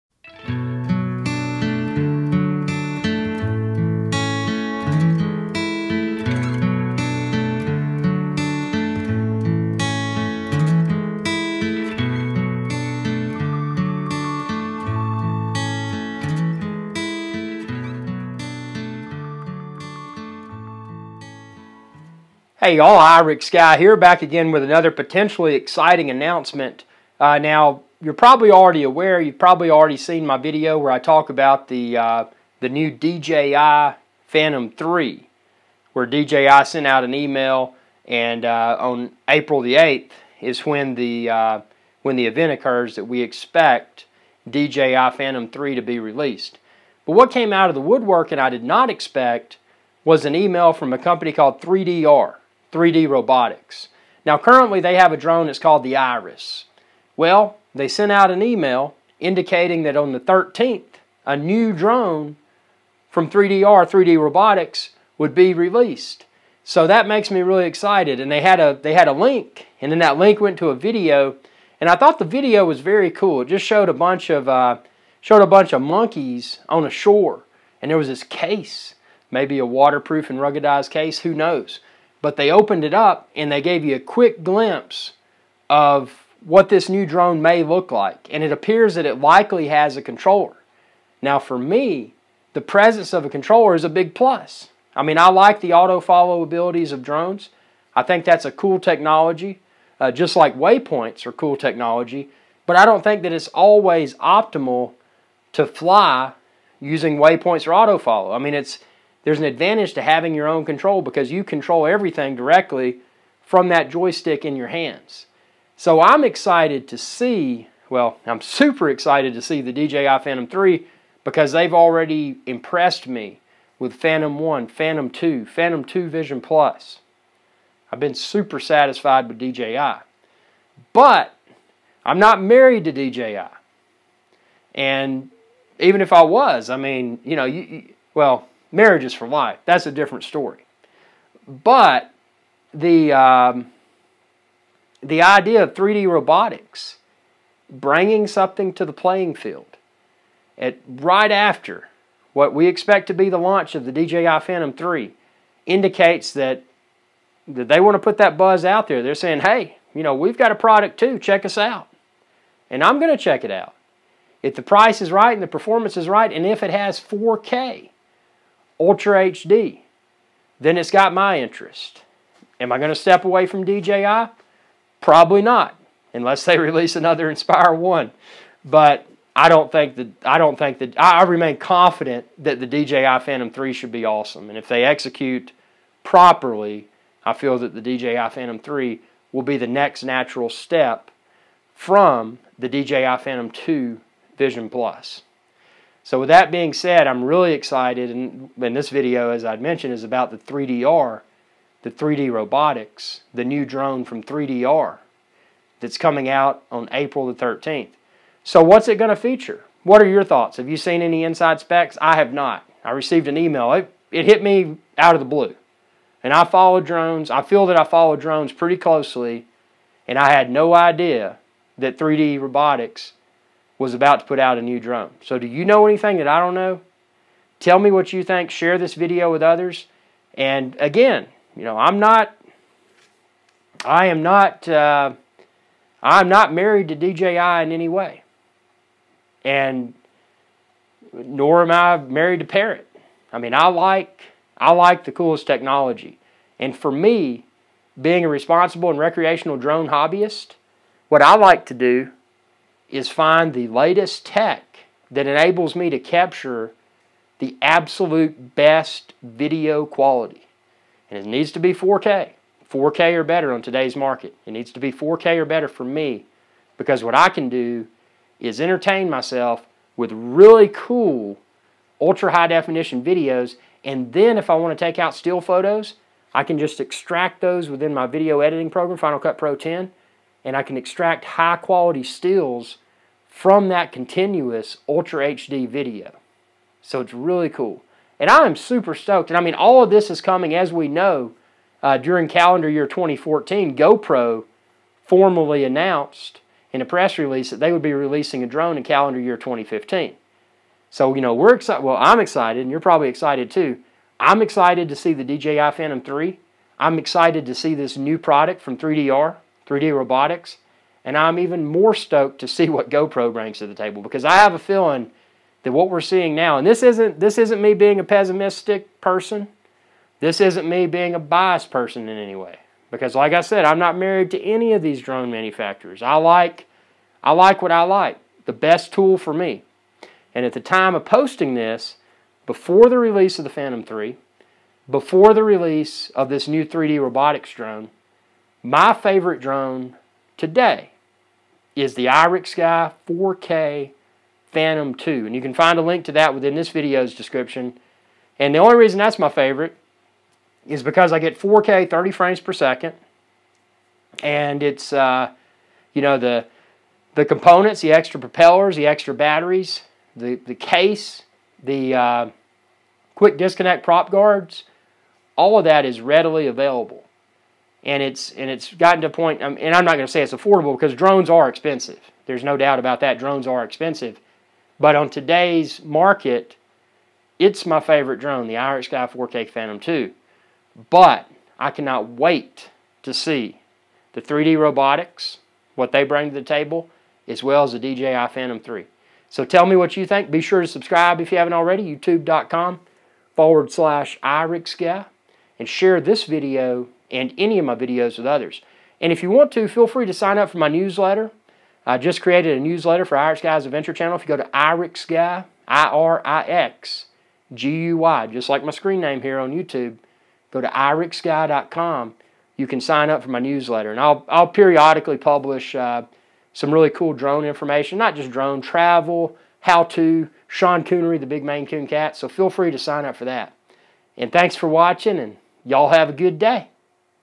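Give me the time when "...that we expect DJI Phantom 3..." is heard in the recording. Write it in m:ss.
0:42.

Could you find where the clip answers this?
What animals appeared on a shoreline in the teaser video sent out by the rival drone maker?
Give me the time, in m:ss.
1:15.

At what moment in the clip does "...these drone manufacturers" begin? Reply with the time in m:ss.
5:24.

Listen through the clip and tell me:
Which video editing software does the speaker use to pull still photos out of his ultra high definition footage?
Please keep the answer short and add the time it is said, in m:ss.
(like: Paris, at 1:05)
Final Cut Pro 10, at 4:38.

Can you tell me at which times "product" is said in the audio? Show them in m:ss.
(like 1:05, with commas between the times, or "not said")
2:40, 5:08.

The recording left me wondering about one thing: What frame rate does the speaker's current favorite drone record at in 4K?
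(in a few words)
30 frames per second.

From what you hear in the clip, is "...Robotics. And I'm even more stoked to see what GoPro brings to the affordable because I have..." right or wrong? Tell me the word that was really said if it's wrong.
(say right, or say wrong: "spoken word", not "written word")
wrong: "table", not "affordable".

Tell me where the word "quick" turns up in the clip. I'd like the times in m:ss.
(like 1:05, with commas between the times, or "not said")
1:23, 6:03.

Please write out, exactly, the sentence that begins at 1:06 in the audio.
So that makes me really excited.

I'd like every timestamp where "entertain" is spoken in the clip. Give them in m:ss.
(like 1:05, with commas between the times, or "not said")
4:28.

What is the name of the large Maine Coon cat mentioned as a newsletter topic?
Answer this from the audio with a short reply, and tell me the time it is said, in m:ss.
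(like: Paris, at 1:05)
Sean Coonery, at 7:00.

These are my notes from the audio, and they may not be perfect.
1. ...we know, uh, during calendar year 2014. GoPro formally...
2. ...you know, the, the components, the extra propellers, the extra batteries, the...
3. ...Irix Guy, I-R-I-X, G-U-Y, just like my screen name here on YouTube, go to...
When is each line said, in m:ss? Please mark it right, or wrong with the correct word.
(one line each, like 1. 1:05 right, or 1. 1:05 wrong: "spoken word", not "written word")
1. 4:50 right
2. 5:55 right
3. 6:44 right.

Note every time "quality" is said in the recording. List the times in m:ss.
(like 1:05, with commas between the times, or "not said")
4:19, 4:41.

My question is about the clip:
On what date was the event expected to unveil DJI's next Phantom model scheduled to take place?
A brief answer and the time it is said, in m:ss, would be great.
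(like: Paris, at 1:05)
April 8, at 0:39.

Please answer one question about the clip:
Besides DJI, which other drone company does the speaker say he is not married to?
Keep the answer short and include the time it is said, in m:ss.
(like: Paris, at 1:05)
Parrot, at 4:02.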